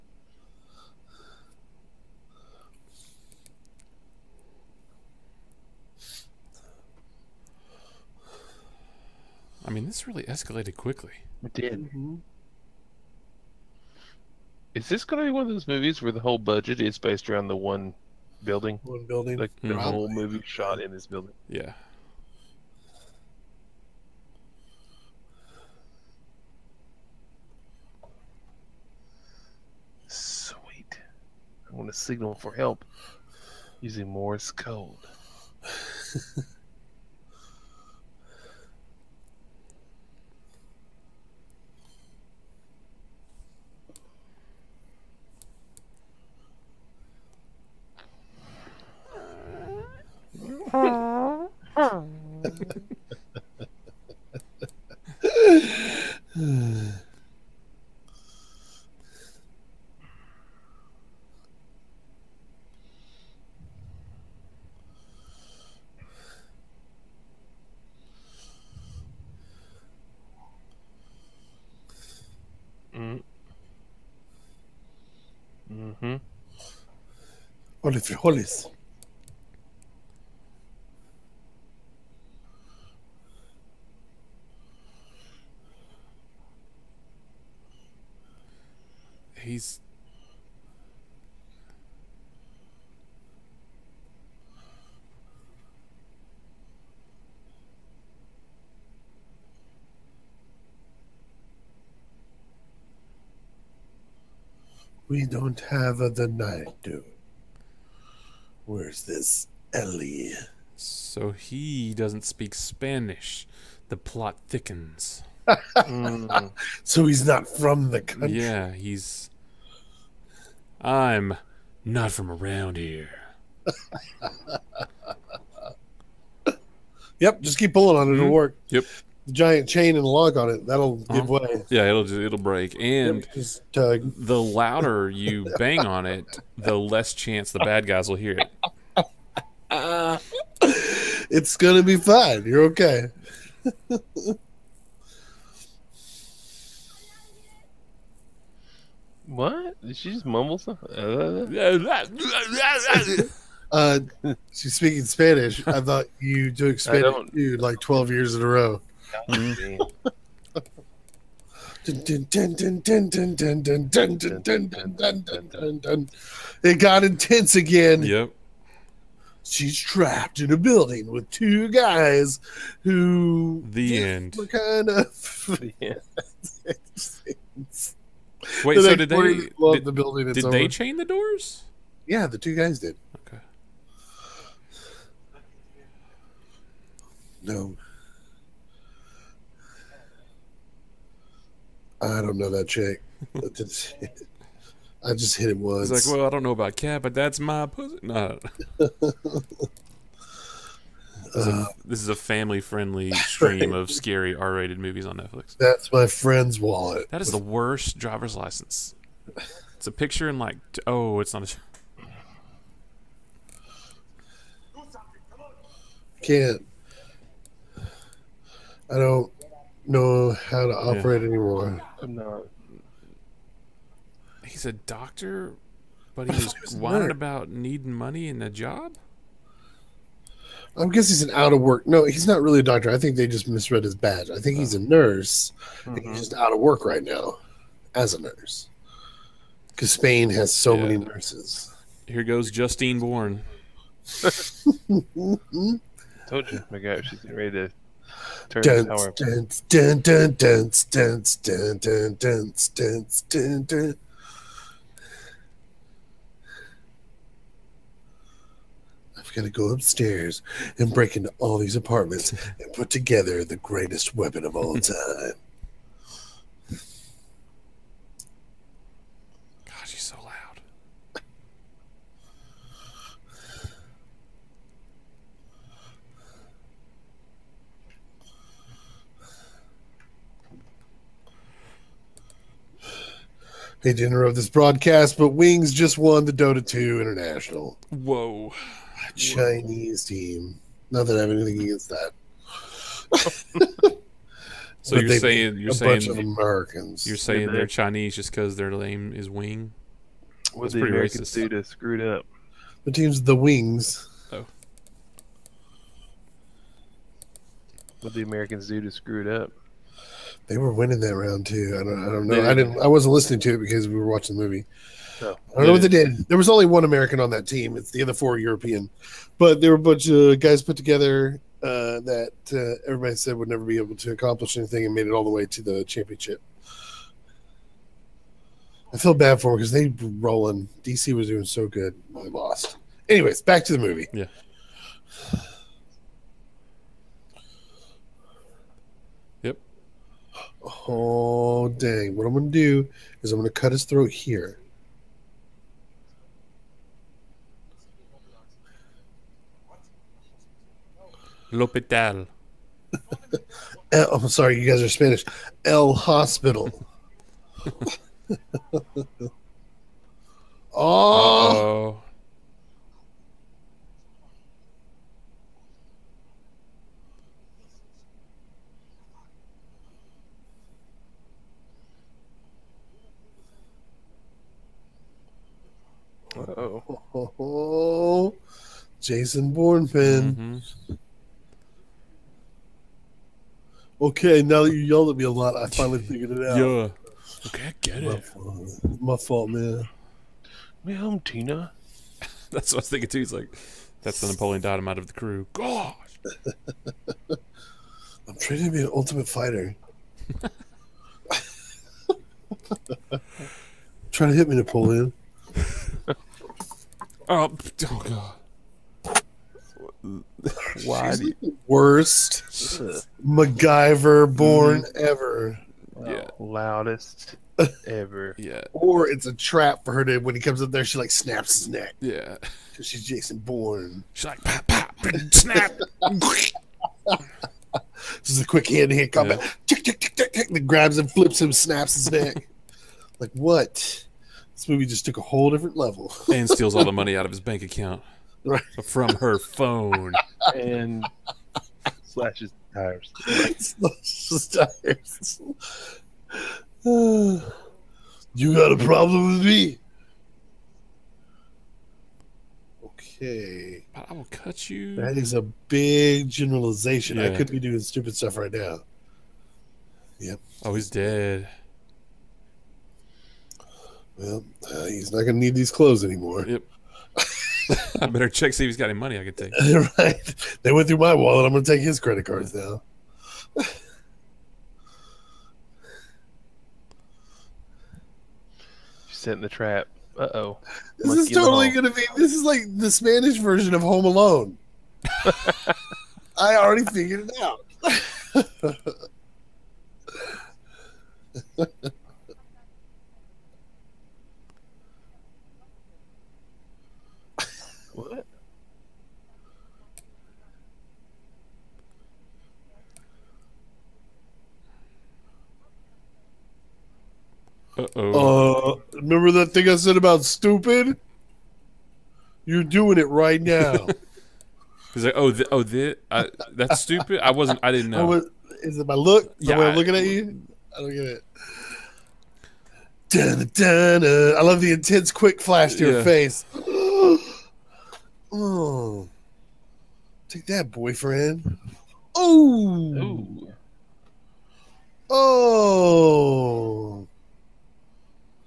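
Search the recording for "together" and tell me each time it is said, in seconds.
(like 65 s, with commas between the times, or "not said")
262 s, 320 s.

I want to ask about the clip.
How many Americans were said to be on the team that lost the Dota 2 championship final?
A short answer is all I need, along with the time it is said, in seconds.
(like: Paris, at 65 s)
1, at 316 s.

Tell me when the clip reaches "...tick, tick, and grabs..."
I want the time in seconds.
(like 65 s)
430 s.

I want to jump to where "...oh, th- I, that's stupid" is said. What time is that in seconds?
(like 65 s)
515 s.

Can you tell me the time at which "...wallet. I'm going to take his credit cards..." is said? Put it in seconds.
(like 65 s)
471 s.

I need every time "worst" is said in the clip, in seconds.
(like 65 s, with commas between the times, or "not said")
207 s, 411 s.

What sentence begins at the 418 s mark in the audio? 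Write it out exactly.
yeah, or it's a trap for her to when he comes up there, she like snaps his neck.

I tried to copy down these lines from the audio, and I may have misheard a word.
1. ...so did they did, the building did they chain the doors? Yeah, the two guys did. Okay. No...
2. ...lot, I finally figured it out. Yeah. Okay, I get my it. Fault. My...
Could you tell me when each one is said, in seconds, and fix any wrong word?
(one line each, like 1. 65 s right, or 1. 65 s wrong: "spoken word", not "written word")
1. 178 s right
2. 385 s right.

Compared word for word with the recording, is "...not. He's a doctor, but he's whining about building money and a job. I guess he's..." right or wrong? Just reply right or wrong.
wrong.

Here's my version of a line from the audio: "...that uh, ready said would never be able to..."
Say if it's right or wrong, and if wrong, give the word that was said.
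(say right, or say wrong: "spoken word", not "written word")
wrong: "everybody", not "ready".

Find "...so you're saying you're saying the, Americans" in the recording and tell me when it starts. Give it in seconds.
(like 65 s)
294 s.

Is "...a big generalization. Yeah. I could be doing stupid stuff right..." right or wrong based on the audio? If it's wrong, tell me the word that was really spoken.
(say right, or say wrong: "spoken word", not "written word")
right.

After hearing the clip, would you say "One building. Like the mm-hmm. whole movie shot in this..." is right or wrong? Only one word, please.
right.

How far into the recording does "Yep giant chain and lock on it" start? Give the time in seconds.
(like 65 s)
128 s.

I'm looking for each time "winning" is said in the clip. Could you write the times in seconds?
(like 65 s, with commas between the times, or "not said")
310 s.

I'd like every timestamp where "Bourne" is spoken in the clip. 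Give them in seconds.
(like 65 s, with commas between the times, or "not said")
242 s, 379 s, 423 s.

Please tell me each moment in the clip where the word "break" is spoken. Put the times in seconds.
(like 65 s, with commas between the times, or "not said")
132 s, 260 s.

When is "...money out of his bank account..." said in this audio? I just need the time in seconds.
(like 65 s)
436 s.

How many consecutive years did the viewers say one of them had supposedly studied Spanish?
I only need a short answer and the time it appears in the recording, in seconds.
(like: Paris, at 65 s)
12, at 157 s.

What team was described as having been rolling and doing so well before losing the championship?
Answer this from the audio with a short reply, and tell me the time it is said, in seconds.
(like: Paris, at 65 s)
DC, at 330 s.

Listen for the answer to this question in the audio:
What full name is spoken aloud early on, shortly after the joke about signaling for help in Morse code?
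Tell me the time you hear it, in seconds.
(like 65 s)
77 s.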